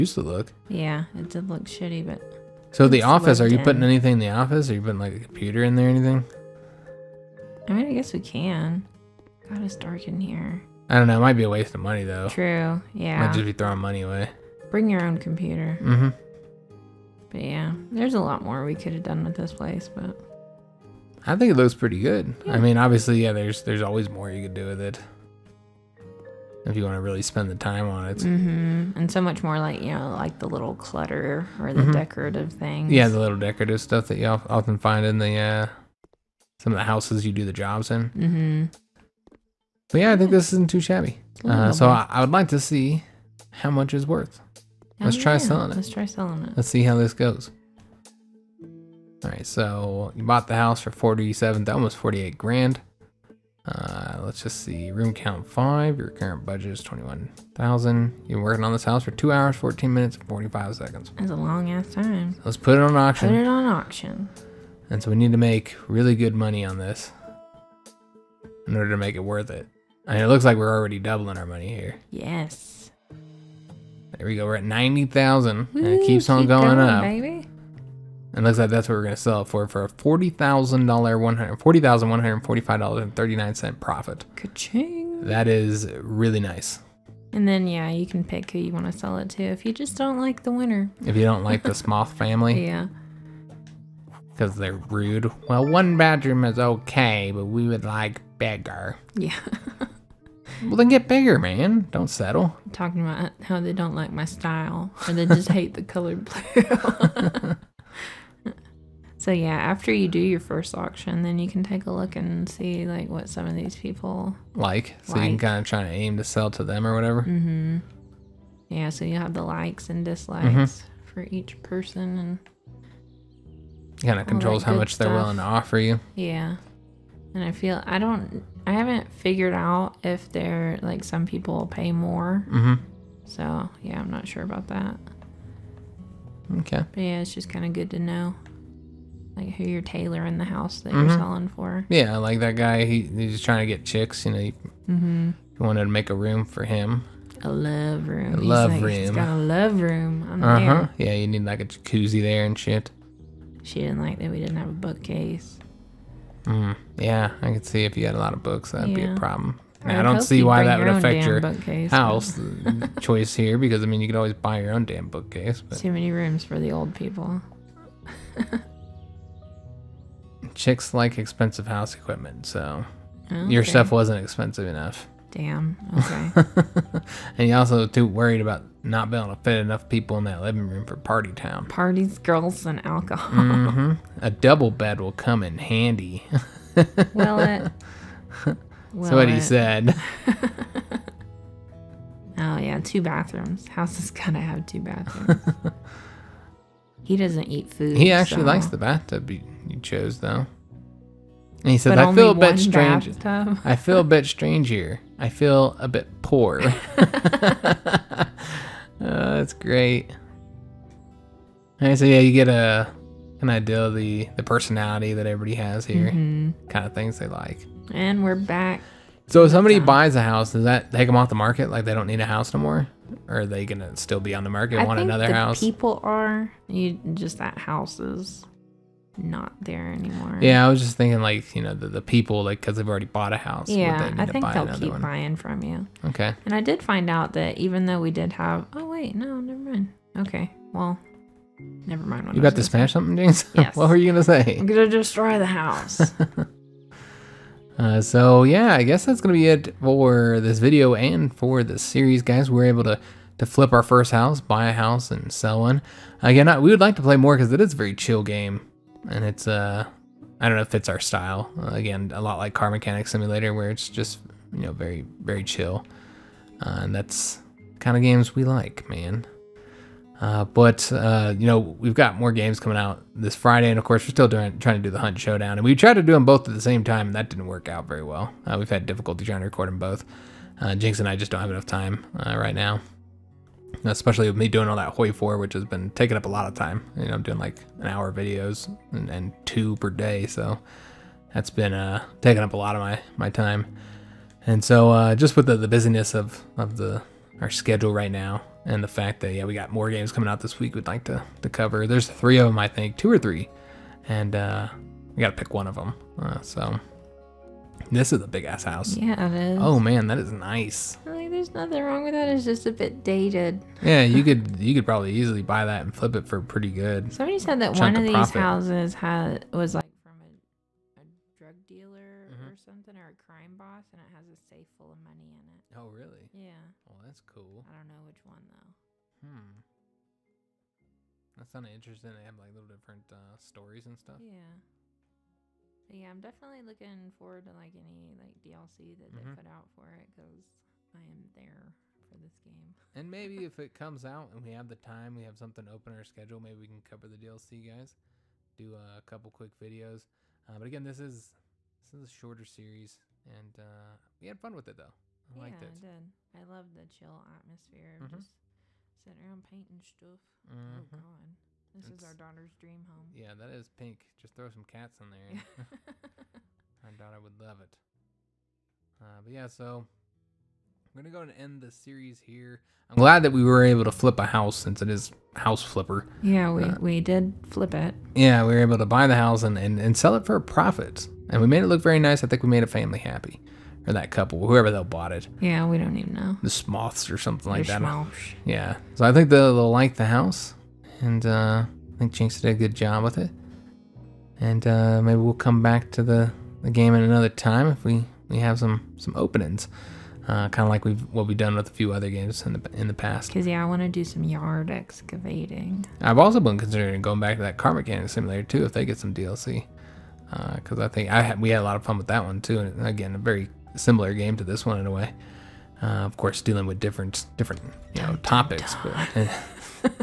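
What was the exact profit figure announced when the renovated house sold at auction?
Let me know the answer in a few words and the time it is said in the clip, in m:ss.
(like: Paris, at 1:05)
$40,145.39, at 1:21.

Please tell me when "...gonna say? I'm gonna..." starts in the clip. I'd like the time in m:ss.
4:04.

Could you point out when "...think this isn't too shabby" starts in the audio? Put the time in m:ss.
0:40.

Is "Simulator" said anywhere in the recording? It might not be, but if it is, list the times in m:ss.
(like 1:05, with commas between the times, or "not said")
4:23, 6:48.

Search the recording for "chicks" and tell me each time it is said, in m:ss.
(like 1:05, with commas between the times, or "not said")
2:23, 2:50.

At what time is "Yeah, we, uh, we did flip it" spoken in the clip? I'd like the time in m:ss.
6:16.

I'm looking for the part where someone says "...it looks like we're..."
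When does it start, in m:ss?
1:10.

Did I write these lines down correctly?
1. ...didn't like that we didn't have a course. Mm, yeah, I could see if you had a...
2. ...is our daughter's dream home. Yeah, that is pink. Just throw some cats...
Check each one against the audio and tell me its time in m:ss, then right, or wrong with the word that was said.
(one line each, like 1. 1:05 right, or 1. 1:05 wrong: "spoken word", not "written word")
1. 2:33 wrong: "bookcase", not "course"
2. 6:02 right.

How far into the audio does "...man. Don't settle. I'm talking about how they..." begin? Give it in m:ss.
1:41.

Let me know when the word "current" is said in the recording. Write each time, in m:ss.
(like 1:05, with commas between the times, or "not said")
0:56.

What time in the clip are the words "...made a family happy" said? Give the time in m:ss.
6:22.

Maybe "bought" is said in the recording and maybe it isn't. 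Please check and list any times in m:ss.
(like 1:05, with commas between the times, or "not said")
0:50, 3:53, 6:24.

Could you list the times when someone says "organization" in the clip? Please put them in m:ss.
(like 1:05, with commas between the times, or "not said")
not said.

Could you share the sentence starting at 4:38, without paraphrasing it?
Uh, we've had difficulty trying to record them both.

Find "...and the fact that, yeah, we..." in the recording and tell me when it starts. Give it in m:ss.
4:58.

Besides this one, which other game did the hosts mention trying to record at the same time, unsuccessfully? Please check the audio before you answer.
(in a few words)
Hunt Showdown.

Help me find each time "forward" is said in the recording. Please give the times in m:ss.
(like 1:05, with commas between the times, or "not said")
5:37.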